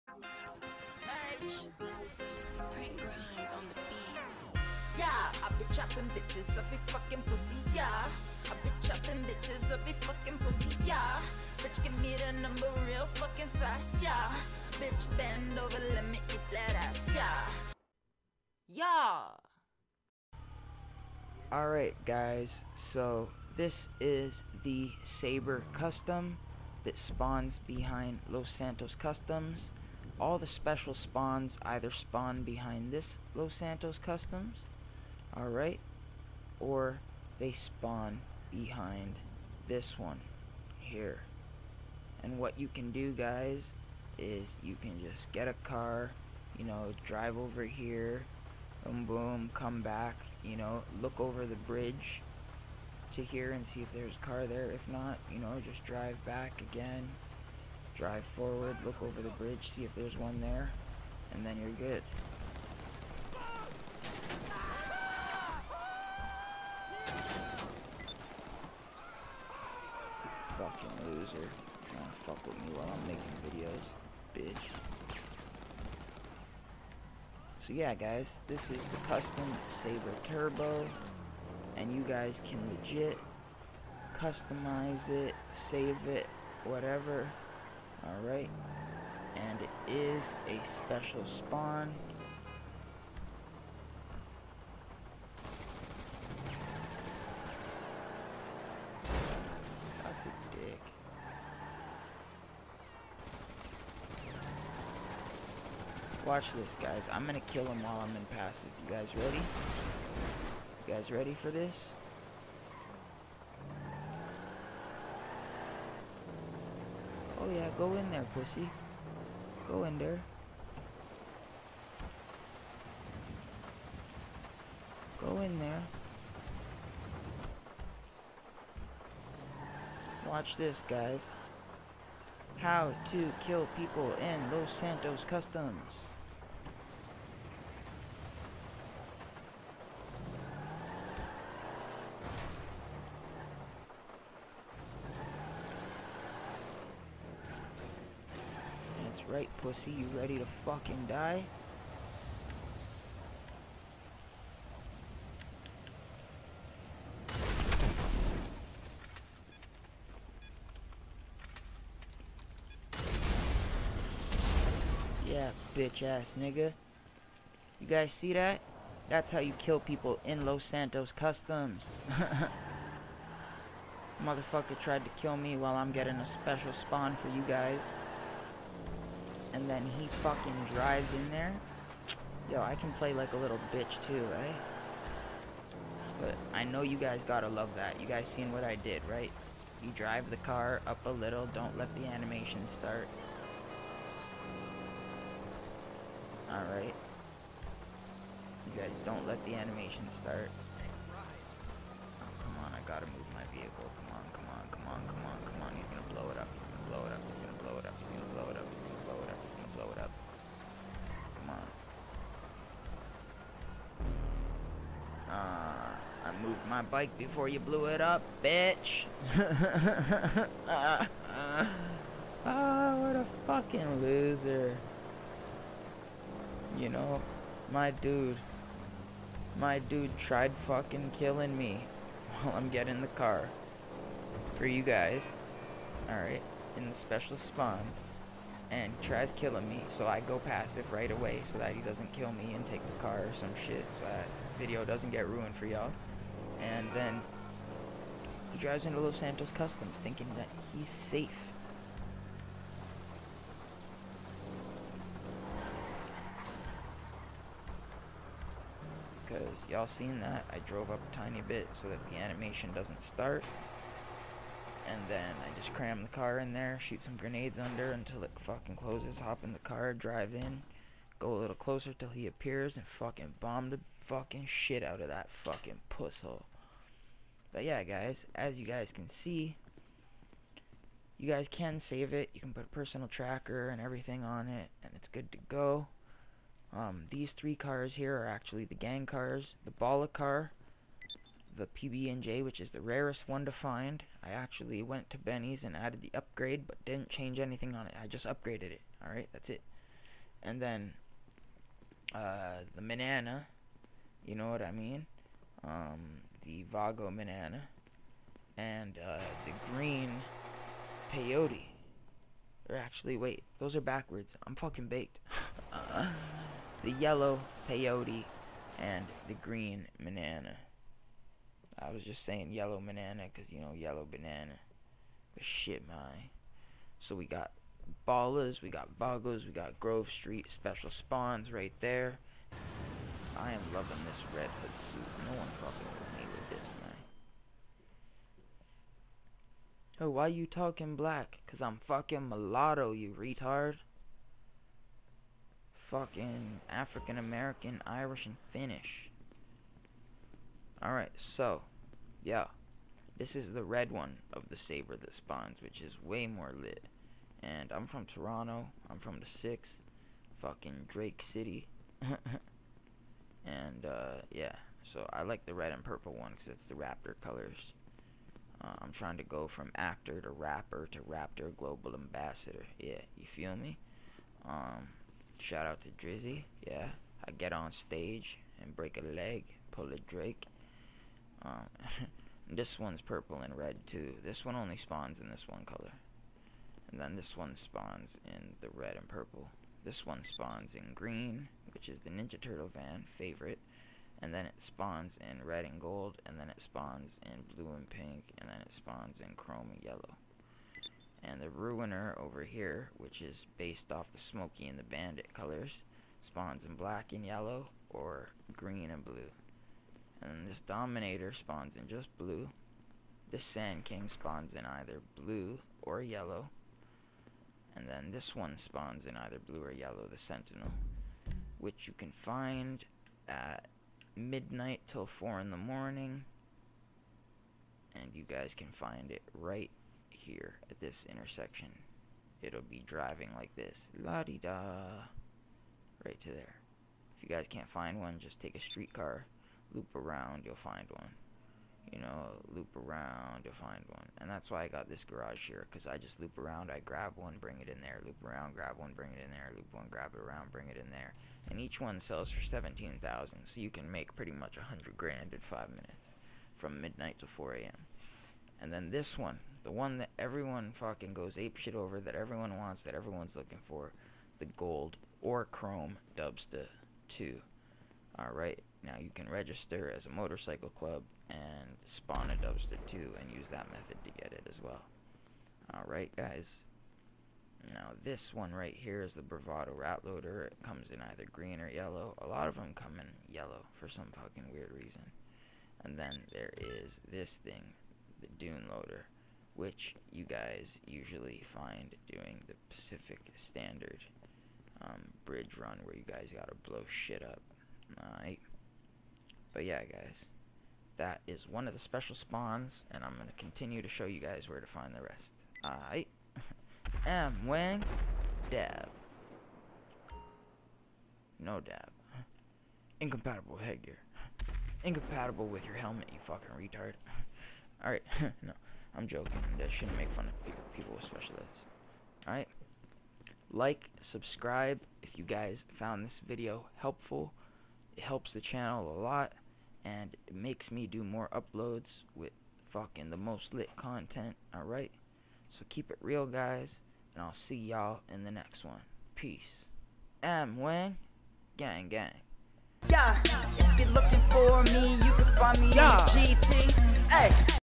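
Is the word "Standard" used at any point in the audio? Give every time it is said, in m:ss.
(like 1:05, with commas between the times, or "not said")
8:13.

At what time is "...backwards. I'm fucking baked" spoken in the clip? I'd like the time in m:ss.
5:13.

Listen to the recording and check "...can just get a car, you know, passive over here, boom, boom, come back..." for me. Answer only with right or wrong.
wrong.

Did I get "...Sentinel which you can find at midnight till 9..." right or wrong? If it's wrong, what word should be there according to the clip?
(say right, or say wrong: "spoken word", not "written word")
wrong: "4", not "9".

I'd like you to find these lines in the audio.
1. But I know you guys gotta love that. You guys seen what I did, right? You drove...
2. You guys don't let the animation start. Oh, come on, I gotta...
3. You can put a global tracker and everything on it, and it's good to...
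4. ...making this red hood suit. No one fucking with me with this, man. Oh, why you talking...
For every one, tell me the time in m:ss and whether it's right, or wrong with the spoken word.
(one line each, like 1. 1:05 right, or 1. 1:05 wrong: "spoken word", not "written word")
1. 3:06 wrong: "drive", not "drove"
2. 3:18 right
3. 4:42 wrong: "personal", not "global"
4. 5:33 wrong: "loving", not "making".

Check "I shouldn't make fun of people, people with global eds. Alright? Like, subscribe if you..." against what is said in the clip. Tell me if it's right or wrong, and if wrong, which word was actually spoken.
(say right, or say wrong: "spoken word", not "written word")
wrong: "special", not "global".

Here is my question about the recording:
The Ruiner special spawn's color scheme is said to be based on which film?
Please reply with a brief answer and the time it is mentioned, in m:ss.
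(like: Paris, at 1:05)
Smokey and the Bandit, at 6:44.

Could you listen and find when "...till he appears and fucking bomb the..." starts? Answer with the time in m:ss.
4:31.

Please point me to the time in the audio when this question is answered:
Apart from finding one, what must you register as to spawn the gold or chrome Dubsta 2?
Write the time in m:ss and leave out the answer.
7:50.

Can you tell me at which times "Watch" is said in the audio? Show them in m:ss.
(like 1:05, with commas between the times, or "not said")
1:46, 2:10.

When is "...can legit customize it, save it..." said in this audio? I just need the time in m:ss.
1:22.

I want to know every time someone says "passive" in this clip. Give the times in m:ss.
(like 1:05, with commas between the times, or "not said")
1:48, 4:00.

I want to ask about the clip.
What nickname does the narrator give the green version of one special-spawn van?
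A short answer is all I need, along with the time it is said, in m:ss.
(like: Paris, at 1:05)
Ninja Turtle van, at 6:32.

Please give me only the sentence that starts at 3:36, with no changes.
my bike before you blew it up, bitch.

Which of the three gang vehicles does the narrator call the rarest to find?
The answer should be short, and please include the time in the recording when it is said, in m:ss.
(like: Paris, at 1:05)
PB&J, at 4:51.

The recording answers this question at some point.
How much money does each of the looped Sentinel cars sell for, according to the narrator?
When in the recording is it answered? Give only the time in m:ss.
7:32.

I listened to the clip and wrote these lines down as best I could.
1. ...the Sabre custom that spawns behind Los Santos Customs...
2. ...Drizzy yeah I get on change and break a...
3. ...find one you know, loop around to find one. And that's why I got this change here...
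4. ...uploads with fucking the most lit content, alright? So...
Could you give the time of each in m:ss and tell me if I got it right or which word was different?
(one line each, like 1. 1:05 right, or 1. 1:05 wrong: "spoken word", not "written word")
1. 0:24 right
2. 6:16 wrong: "stage", not "change"
3. 7:20 wrong: "garage", not "change"
4. 8:51 right.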